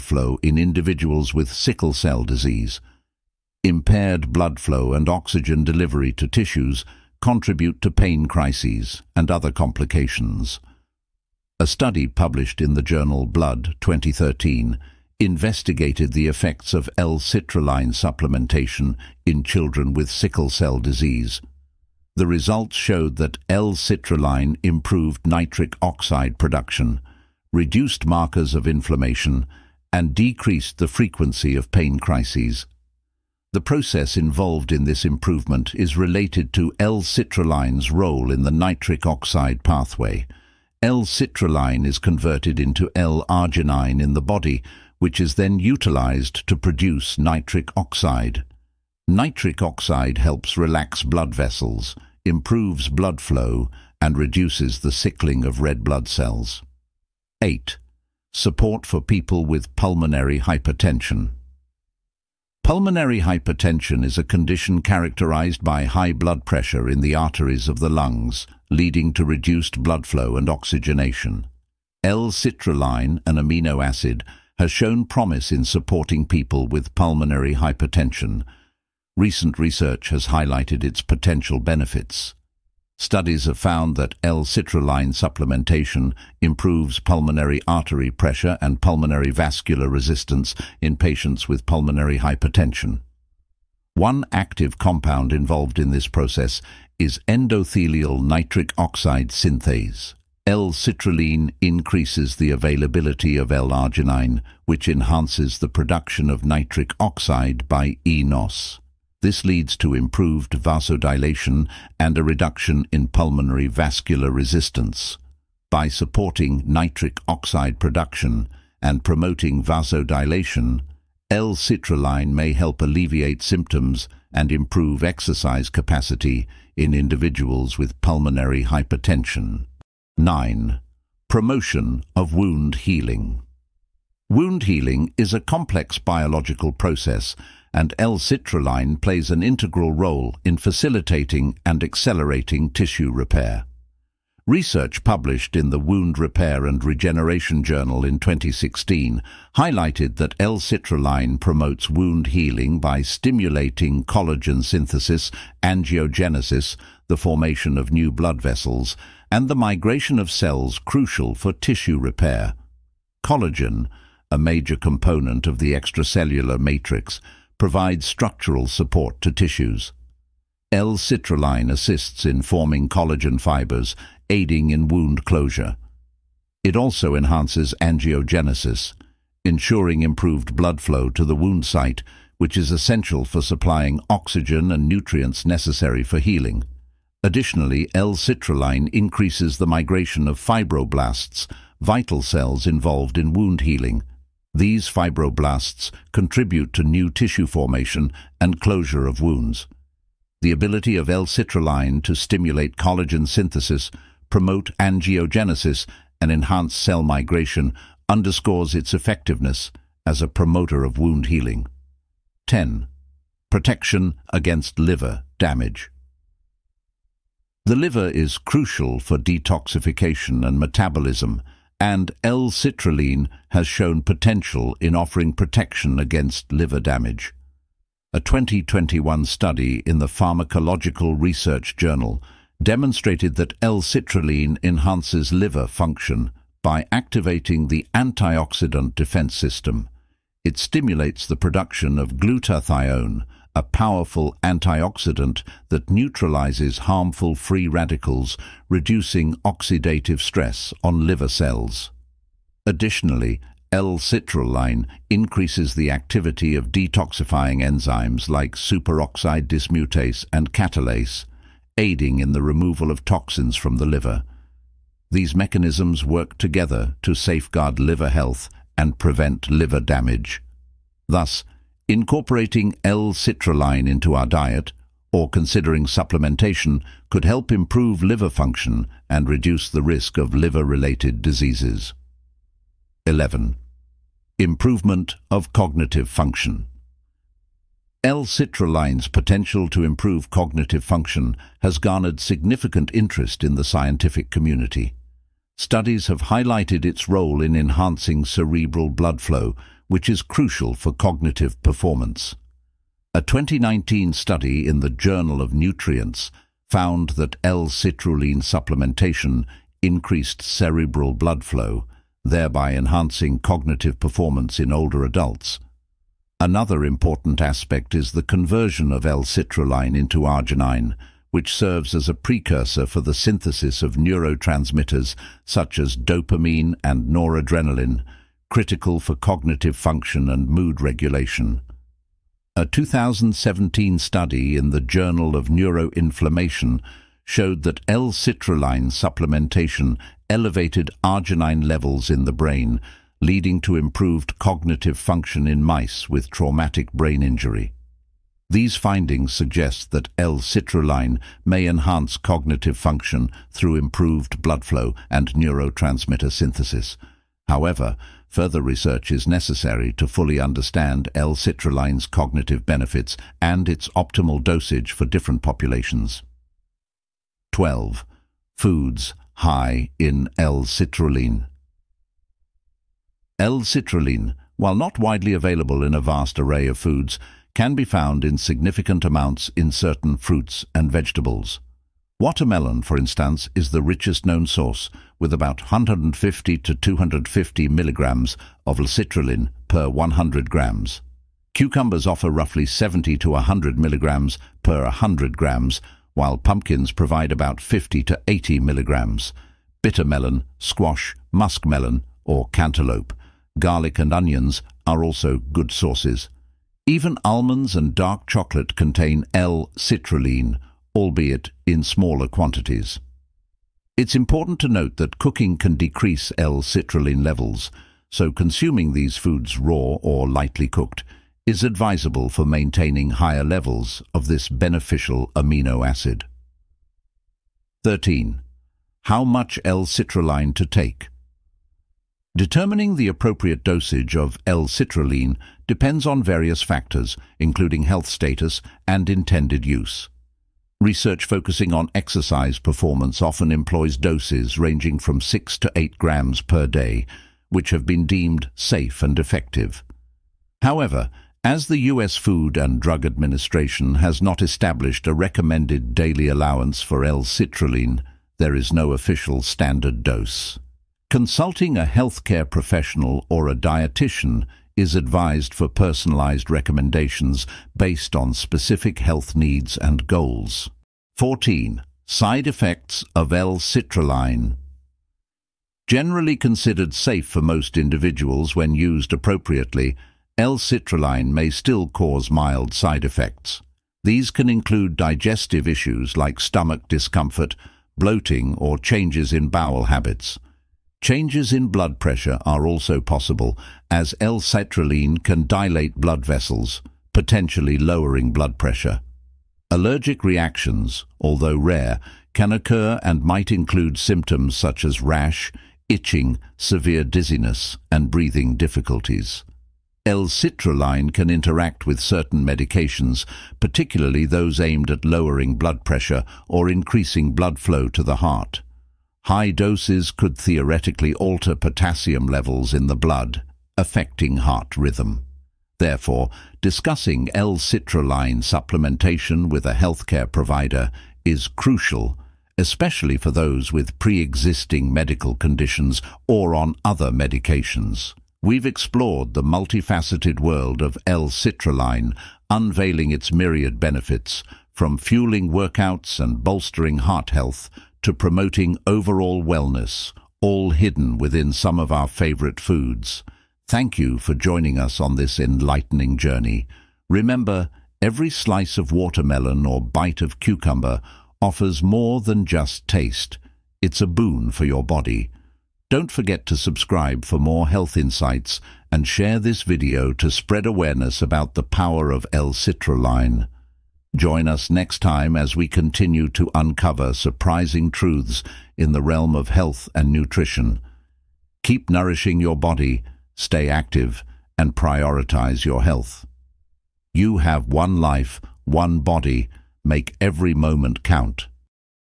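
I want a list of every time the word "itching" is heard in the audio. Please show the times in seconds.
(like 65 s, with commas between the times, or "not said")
505 s.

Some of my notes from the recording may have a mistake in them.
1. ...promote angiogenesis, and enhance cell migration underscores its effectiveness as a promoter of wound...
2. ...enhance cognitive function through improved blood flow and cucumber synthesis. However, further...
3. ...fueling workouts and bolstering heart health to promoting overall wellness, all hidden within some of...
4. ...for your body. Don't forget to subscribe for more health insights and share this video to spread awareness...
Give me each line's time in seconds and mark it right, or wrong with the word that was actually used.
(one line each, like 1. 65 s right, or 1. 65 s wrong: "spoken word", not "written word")
1. 204 s right
2. 351 s wrong: "neurotransmitter", not "cucumber"
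3. 544 s right
4. 564 s right.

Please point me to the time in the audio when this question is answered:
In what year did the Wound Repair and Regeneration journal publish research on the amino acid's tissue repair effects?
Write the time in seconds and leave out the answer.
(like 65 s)
148 s.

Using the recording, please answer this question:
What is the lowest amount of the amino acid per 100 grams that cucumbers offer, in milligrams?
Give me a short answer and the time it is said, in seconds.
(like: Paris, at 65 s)
70, at 392 s.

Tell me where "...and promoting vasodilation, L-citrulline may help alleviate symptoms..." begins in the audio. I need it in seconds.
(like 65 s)
118 s.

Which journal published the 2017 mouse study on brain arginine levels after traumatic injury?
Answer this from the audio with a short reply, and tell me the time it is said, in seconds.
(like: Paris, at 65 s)
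Journal of Neuroinflammation, at 334 s.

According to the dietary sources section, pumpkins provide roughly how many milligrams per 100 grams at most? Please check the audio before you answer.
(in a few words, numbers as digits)
80.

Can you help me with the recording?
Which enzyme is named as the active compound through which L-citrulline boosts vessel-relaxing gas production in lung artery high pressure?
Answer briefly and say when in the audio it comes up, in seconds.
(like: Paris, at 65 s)
Endothelial nitric oxide synthase, at 97 s.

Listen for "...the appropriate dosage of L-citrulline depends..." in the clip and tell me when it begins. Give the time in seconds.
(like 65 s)
432 s.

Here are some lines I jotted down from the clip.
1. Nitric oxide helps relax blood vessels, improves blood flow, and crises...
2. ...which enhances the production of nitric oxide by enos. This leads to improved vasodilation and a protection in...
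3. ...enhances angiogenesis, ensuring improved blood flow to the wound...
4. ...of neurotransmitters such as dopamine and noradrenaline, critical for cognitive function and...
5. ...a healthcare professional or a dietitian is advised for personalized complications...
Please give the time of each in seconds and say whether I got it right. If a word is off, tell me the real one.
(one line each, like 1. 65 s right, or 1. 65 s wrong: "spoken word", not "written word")
1. 49 s wrong: "reduces", not "crises"
2. 104 s wrong: "reduction", not "protection"
3. 177 s right
4. 323 s right
5. 461 s wrong: "recommendations", not "complications".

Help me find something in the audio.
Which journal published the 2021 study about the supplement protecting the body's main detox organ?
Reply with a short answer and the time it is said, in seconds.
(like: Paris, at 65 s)
Pharmacological Research Journal, at 230 s.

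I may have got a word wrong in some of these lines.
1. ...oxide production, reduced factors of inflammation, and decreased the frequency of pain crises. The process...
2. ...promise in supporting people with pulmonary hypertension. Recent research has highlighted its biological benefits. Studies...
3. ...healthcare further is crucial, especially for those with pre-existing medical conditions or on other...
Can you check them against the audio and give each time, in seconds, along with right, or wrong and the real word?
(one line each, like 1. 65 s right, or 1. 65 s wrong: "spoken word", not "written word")
1. 25 s wrong: "markers", not "factors"
2. 75 s wrong: "potential", not "biological"
3. 529 s wrong: "provider", not "further".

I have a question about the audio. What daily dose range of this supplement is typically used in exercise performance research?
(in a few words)
6 to 8 grams.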